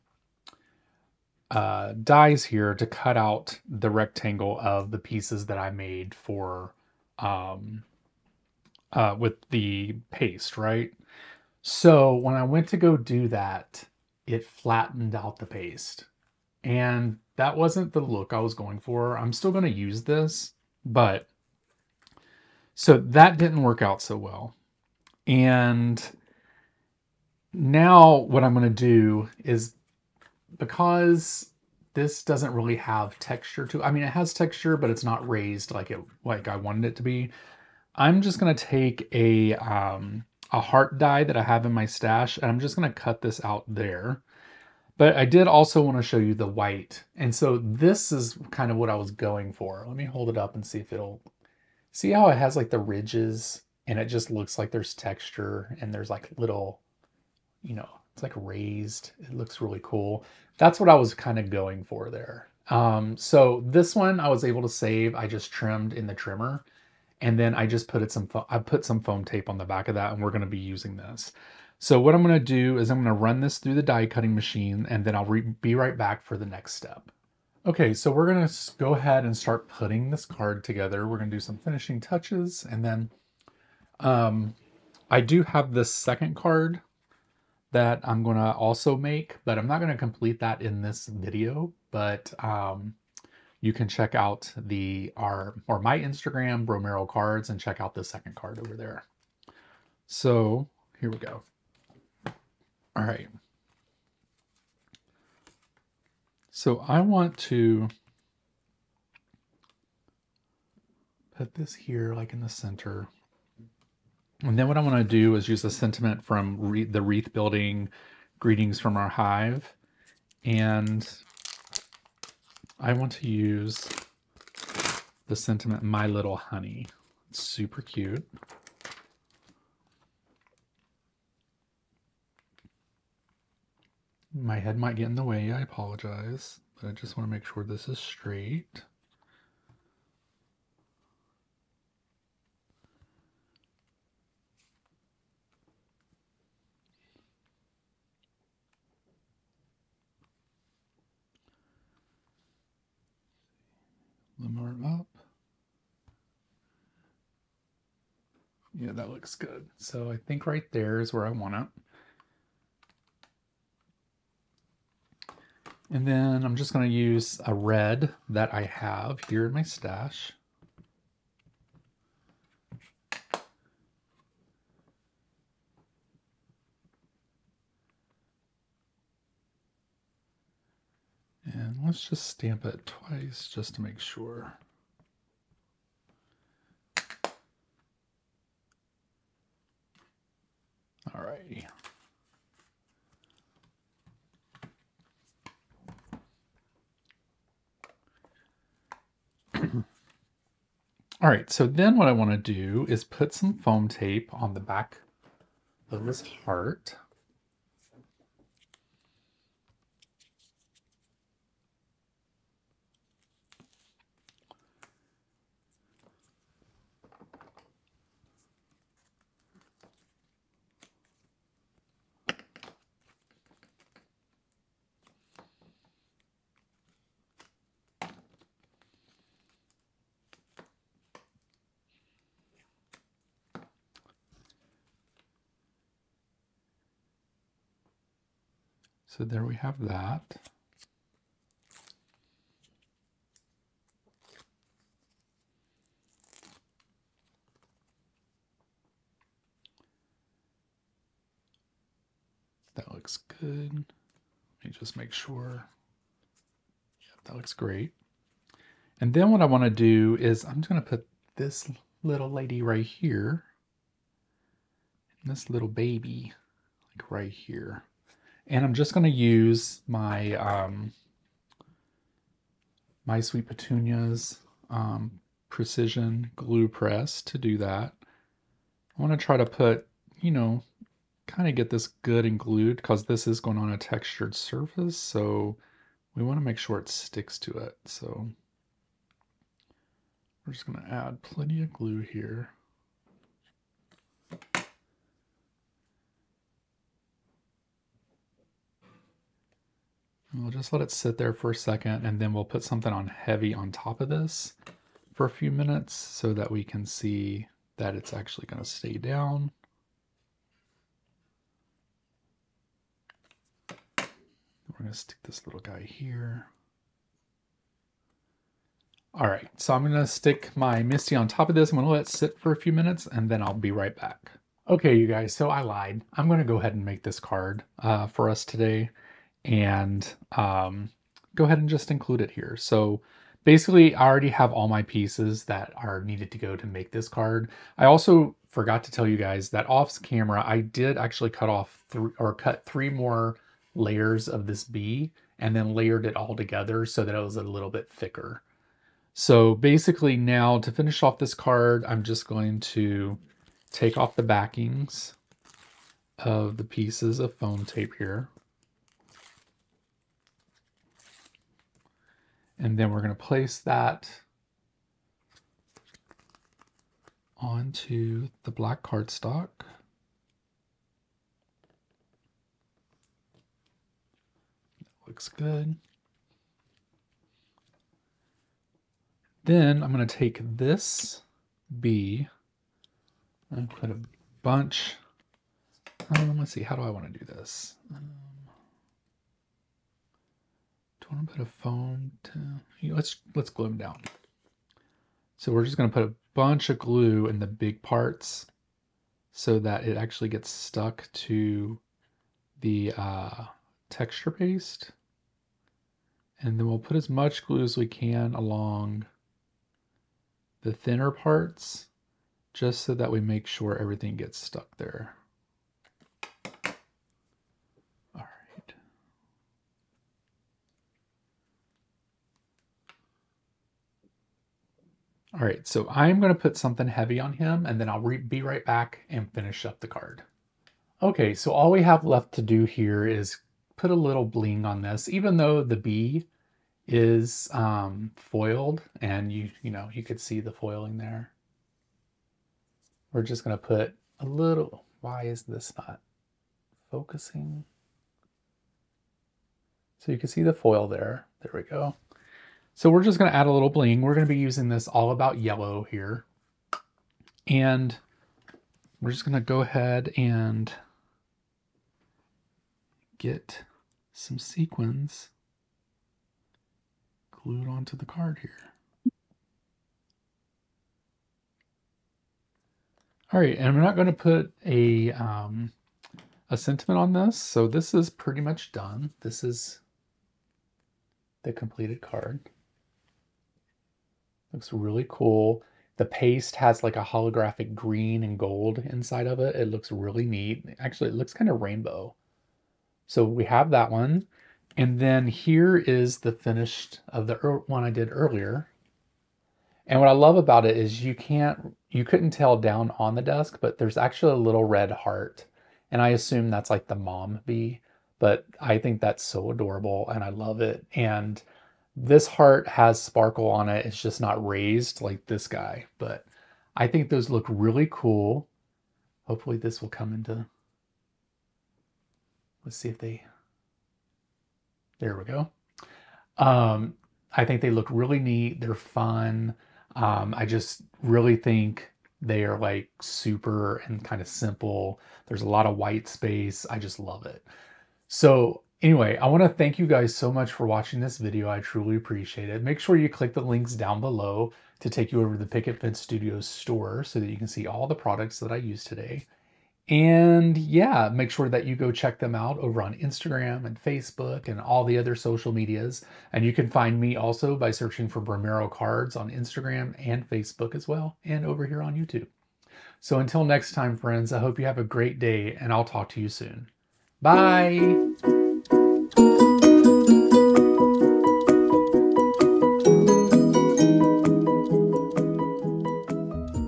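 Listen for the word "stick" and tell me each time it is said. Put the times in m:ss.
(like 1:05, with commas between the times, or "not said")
4:46, 5:14, 5:20.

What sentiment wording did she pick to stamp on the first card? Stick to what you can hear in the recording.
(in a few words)
My Little Honey.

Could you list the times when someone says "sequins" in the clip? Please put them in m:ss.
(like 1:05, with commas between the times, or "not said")
7:44.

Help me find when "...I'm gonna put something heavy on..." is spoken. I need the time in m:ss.
7:05.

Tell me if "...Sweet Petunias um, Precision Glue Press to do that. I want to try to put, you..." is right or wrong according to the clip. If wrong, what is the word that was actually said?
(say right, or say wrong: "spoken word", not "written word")
right.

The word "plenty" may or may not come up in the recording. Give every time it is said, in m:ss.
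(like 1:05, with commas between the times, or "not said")
4:51.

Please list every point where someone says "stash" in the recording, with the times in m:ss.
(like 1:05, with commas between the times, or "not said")
0:41, 2:49.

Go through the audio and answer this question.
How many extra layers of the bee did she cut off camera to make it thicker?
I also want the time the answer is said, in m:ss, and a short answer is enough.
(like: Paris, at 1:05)
3, at 5:42.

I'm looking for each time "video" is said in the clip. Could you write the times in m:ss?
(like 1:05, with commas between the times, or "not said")
1:31, 9:01.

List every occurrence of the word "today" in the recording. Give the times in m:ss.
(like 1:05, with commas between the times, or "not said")
5:28, 9:08.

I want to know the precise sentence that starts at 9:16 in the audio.
And you can find me also by searching for Bromero Cards on Instagram and Facebook as well, and over here on YouTube.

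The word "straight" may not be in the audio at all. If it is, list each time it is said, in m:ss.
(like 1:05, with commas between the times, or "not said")
2:17.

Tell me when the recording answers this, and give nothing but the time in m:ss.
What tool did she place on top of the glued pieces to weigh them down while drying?
5:20.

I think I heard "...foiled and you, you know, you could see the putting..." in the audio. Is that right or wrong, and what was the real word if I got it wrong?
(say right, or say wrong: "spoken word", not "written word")
wrong: "foiling", not "putting".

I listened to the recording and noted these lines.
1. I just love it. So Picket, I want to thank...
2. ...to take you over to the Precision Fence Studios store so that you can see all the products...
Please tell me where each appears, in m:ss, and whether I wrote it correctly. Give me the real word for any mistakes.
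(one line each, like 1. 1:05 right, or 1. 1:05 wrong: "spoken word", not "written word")
1. 8:56 wrong: "Anyway", not "Picket"
2. 9:04 wrong: "Picket", not "Precision".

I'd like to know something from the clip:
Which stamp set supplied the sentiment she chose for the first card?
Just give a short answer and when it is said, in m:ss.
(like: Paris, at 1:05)
Wreath Building Greetings from Our Hive, at 1:57.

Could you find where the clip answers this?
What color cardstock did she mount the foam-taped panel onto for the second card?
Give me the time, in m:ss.
6:08.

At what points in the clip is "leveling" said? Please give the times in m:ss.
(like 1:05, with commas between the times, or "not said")
not said.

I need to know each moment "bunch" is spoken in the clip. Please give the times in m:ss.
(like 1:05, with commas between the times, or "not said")
6:24, 6:36.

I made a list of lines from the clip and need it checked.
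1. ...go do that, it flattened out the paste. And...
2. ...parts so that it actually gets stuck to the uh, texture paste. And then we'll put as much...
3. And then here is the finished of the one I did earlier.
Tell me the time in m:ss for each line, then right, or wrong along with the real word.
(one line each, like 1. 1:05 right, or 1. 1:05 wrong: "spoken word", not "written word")
1. 0:12 right
2. 6:37 right
3. 8:14 right.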